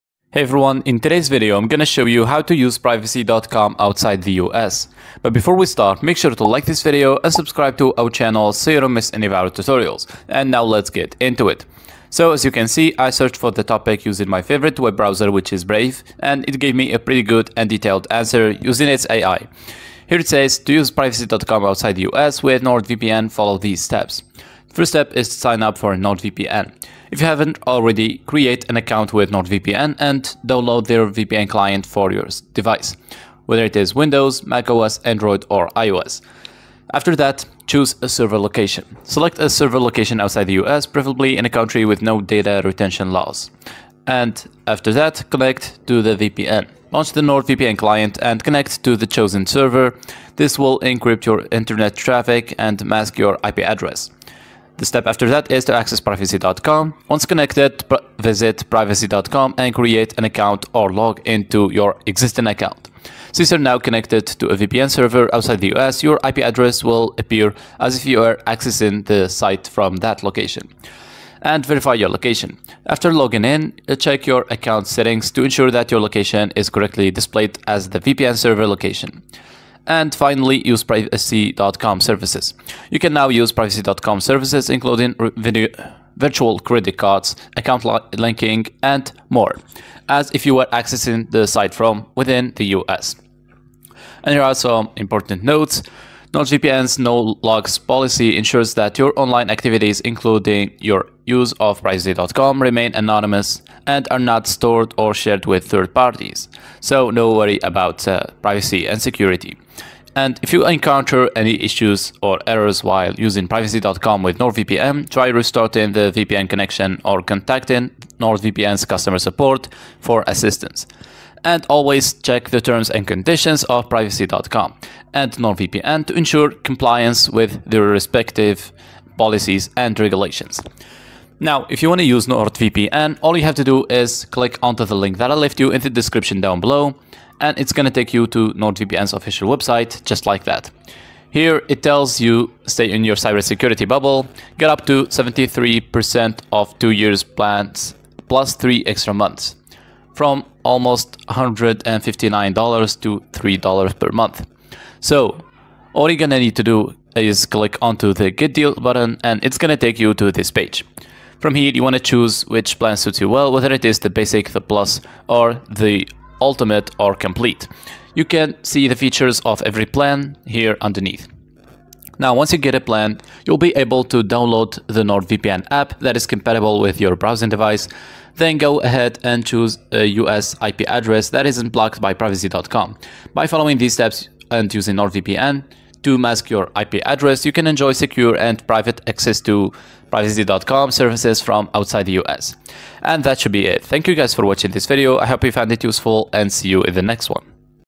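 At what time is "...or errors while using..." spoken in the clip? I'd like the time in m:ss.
1:52.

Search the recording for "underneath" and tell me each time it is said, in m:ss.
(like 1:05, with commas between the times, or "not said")
2:50.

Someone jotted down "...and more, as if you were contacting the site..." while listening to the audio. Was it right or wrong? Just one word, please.
wrong.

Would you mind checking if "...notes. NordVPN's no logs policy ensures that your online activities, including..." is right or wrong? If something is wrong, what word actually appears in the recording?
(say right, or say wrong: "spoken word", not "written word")
right.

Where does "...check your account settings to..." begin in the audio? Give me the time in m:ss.
1:13.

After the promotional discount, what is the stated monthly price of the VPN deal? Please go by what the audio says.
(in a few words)
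$3 per month.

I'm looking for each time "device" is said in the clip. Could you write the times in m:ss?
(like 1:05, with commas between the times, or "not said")
0:32, 2:57.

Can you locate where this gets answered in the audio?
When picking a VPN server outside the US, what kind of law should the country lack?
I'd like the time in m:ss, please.
0:42.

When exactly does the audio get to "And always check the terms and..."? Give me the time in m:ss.
2:01.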